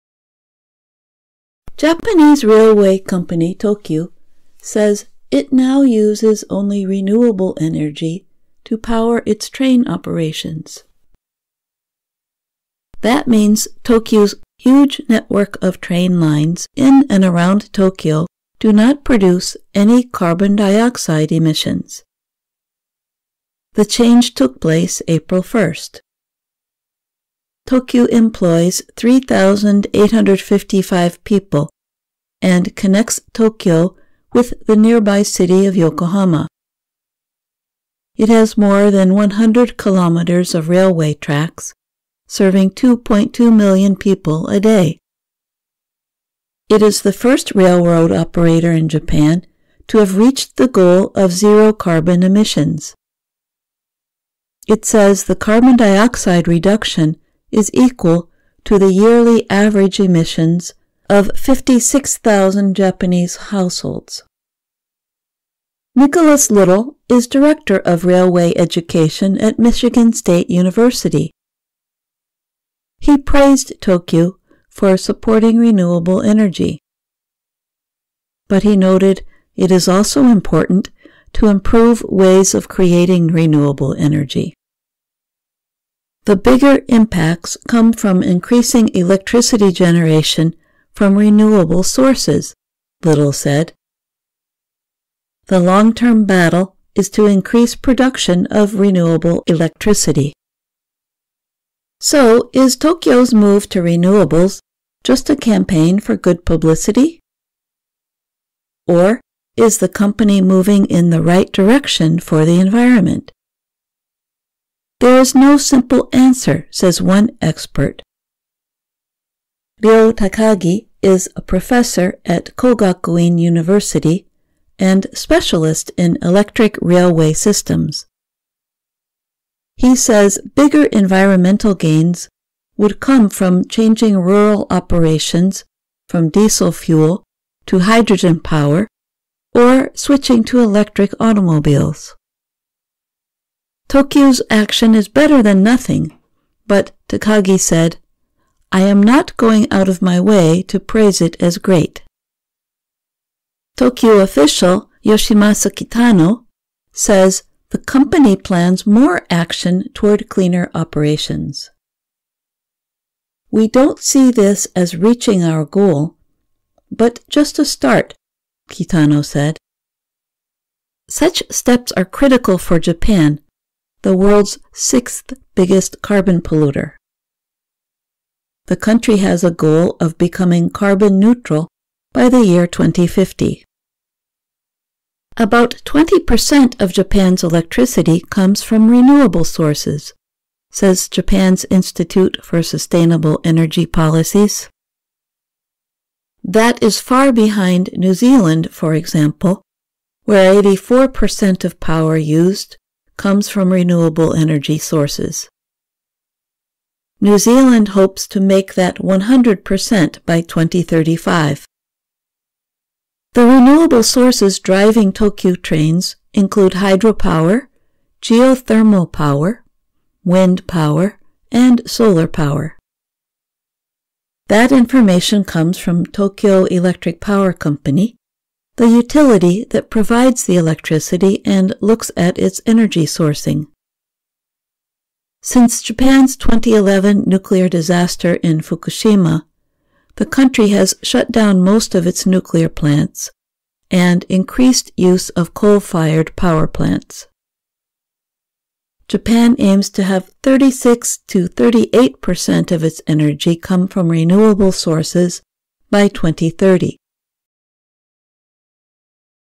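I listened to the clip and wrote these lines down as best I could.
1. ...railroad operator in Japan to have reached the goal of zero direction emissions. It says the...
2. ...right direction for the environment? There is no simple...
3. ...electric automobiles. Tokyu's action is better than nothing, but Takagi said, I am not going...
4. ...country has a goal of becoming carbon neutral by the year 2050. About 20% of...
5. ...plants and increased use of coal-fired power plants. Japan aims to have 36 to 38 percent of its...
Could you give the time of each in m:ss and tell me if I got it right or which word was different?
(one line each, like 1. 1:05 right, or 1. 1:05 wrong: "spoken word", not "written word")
1. 0:47 wrong: "carbon", not "direction"
2. 1:51 right
3. 2:20 right
4. 2:58 right
5. 4:02 right.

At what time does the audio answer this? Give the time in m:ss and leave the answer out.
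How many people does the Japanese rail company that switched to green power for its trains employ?
0:28.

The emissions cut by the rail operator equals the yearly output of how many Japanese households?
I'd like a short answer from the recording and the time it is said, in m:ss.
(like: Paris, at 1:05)
56,000, at 1:01.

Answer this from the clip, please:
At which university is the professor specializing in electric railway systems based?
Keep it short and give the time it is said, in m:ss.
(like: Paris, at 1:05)
Kogakuin University, at 2:02.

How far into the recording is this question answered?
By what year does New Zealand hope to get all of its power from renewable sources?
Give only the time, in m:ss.
3:30.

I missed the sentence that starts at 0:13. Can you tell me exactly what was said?
That means Tokyu's huge network of train lines in and around Tokyo do not produce any carbon dioxide emissions.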